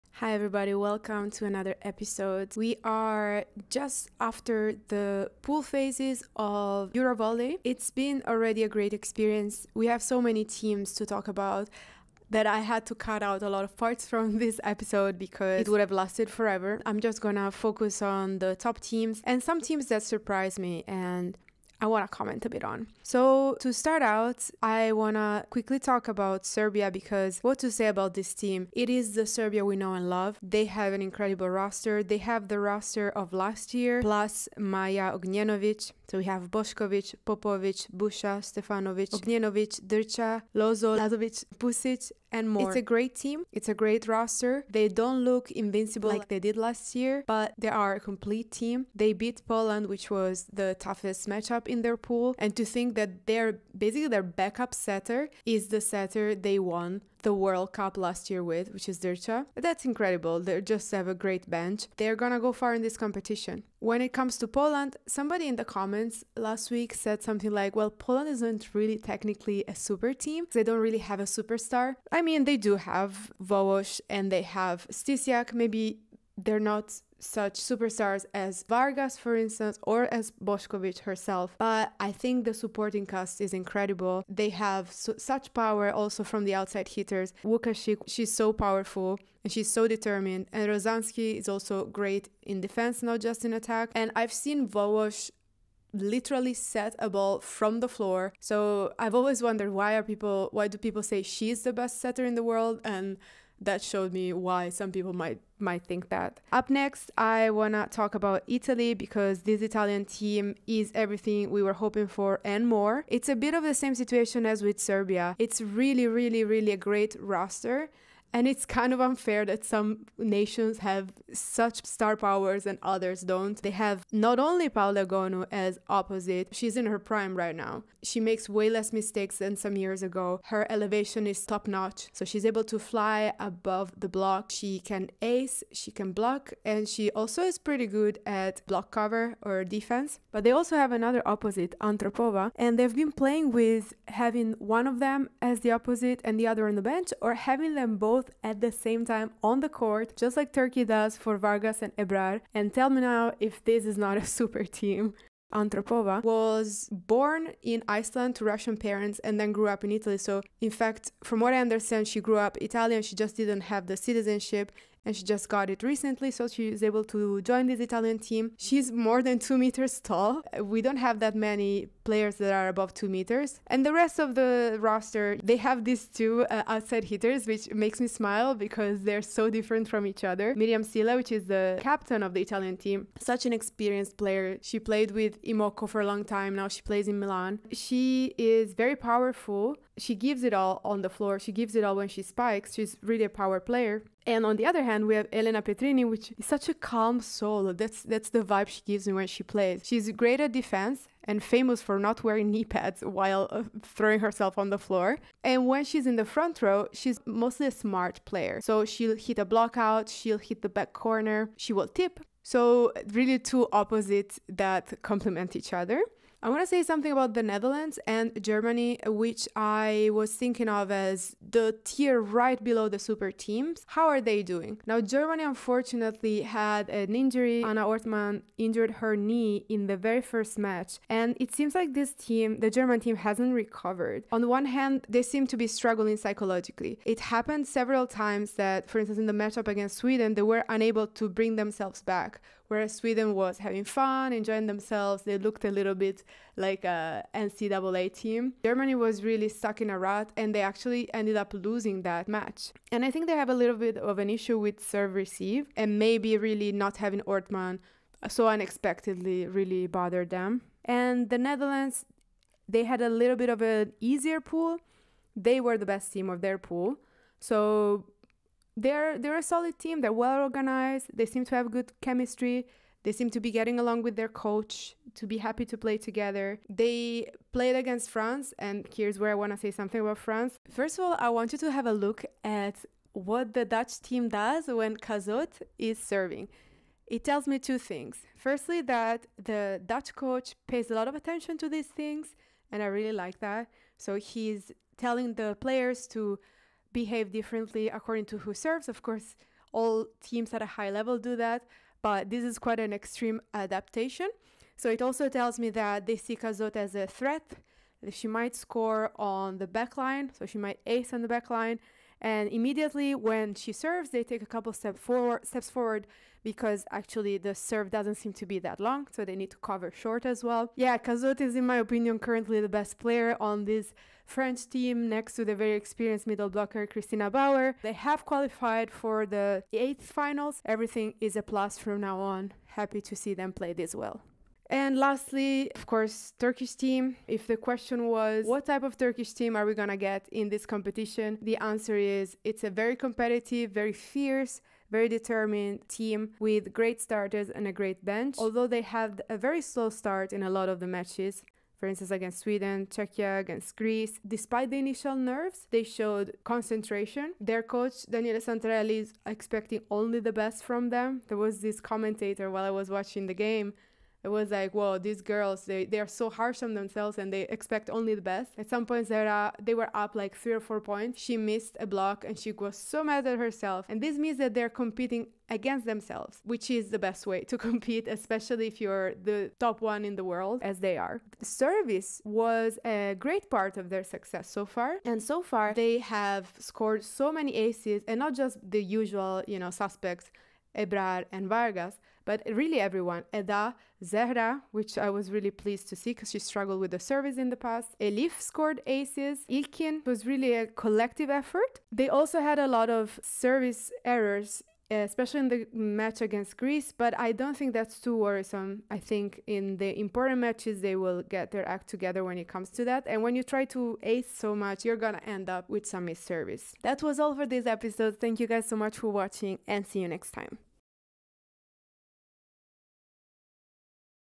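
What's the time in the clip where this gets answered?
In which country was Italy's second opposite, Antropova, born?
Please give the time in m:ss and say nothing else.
2:36.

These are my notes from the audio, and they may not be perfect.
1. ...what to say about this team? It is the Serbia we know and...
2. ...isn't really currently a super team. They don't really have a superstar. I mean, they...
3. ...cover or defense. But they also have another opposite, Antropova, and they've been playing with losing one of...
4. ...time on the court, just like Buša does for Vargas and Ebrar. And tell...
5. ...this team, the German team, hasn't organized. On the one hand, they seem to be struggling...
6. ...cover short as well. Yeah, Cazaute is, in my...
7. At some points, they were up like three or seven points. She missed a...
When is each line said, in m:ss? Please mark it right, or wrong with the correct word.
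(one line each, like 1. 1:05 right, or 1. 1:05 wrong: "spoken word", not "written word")
1. 0:27 right
2. 1:08 wrong: "technically", not "currently"
3. 2:18 wrong: "having", not "losing"
4. 2:29 wrong: "Turkey", not "Buša"
5. 3:51 wrong: "recovered", not "organized"
6. 5:19 right
7. 6:08 wrong: "four", not "seven".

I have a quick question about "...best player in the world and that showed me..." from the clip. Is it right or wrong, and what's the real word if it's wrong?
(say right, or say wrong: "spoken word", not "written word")
wrong: "setter", not "player".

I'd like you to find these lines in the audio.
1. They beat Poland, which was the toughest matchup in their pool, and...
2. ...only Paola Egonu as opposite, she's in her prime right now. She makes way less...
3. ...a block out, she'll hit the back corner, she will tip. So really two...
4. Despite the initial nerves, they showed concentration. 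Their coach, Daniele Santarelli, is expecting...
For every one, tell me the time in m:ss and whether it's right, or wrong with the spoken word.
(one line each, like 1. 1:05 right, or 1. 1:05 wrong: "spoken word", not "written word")
1. 0:48 right
2. 2:04 right
3. 3:29 right
4. 5:54 right.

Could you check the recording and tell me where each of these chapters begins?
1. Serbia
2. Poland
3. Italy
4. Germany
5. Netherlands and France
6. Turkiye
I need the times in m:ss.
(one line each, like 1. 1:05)
1. 0:24
2. 1:03
3. 1:46
4. 3:36
5. 4:20
6. 5:34.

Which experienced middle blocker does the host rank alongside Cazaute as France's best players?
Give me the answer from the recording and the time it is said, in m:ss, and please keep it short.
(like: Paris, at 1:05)
Christina Bauer, at 5:26.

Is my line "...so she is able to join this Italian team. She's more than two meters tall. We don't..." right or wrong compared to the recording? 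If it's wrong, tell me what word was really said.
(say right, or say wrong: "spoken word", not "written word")
right.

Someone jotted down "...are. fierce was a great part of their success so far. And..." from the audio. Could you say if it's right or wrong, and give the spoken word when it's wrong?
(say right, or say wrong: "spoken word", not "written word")
wrong: "service", not "fierce".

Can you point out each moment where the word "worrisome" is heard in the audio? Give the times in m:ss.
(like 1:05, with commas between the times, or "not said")
6:48.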